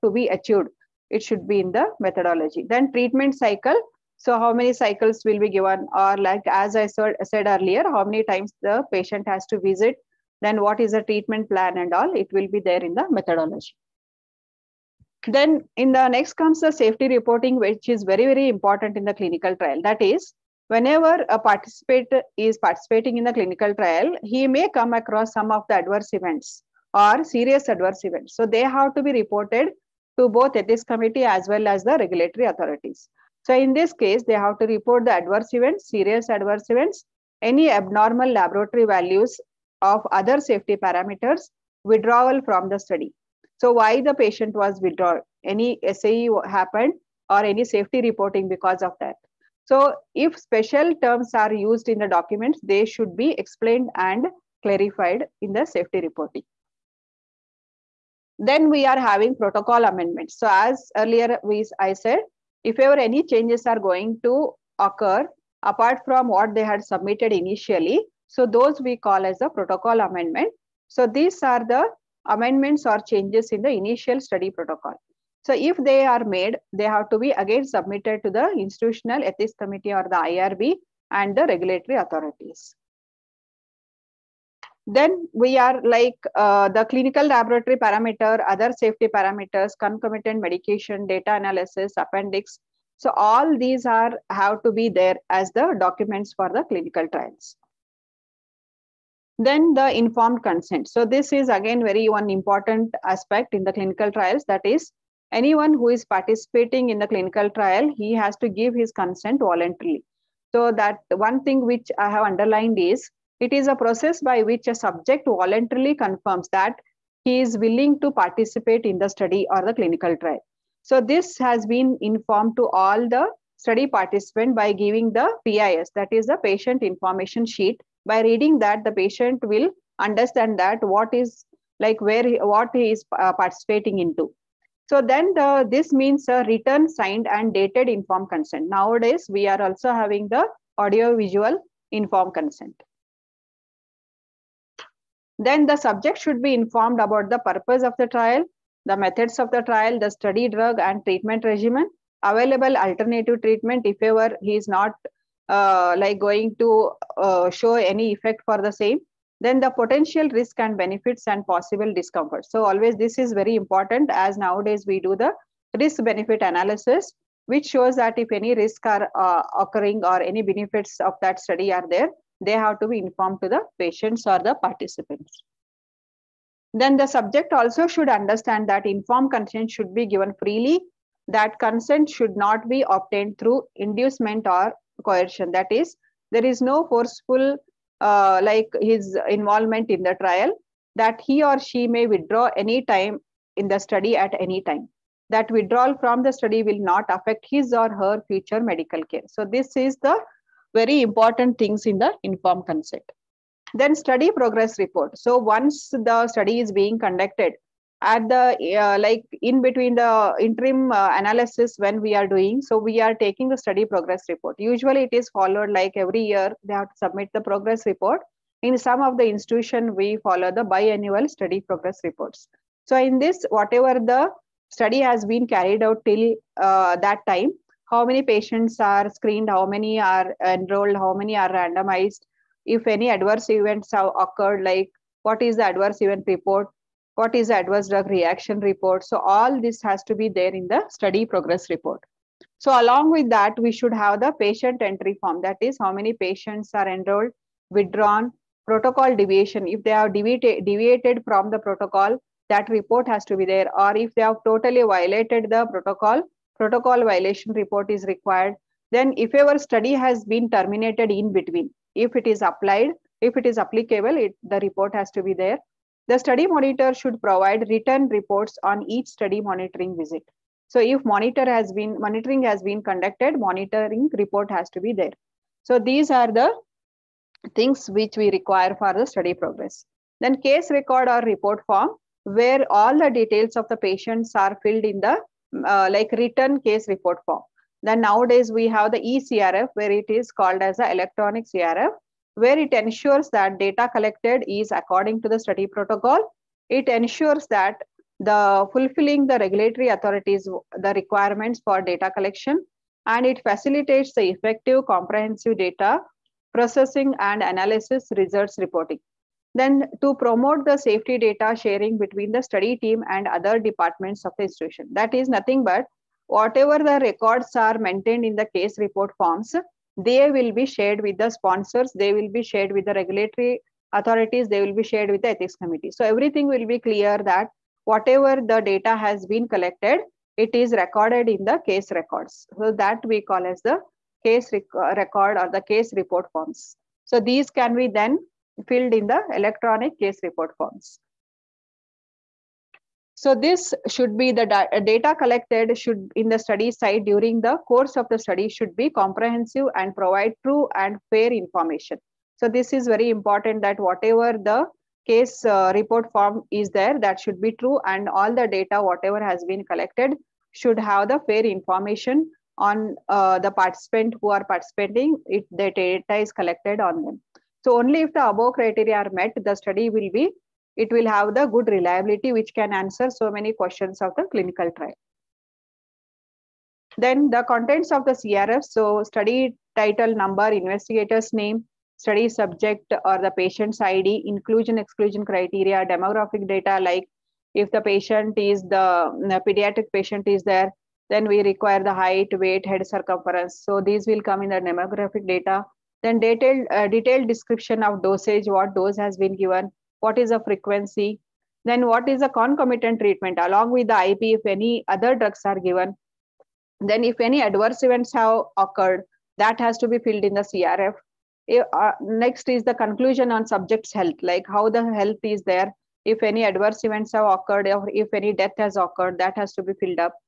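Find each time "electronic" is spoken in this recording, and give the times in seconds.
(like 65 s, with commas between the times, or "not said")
290 s, 339 s.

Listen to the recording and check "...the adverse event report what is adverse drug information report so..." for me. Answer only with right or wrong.
wrong.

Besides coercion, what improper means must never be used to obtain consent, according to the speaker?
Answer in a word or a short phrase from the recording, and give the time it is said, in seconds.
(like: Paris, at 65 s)
Inducement, at 183 s.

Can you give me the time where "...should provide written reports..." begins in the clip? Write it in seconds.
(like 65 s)
266 s.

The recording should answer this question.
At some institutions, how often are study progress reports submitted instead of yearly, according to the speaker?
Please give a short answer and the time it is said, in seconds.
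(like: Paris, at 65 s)
Biannual, at 220 s.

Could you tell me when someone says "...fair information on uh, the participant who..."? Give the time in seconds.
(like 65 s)
361 s.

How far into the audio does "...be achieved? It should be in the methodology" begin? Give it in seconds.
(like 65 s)
0 s.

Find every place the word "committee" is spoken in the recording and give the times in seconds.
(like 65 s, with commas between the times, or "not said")
30 s, 79 s, 325 s.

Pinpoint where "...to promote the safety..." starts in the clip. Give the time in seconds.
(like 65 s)
310 s.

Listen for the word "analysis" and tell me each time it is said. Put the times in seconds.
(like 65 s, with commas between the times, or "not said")
91 s, 166 s, 211 s, 307 s.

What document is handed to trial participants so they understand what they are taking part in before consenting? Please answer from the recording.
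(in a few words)
Patient information sheet.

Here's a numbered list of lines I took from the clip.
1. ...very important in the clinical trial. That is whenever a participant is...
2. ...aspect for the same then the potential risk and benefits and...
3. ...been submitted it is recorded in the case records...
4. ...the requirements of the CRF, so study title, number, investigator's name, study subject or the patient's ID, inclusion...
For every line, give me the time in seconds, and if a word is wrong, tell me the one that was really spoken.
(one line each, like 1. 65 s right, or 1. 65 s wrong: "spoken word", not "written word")
1. 18 s right
2. 158 s wrong: "effect", not "aspect"
3. 329 s wrong: "collected", not "submitted"
4. 377 s wrong: "contents", not "requirements".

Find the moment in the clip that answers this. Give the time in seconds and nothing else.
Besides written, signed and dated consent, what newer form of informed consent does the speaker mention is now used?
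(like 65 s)
140 s.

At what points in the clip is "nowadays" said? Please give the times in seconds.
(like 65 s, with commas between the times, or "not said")
138 s, 164 s, 288 s.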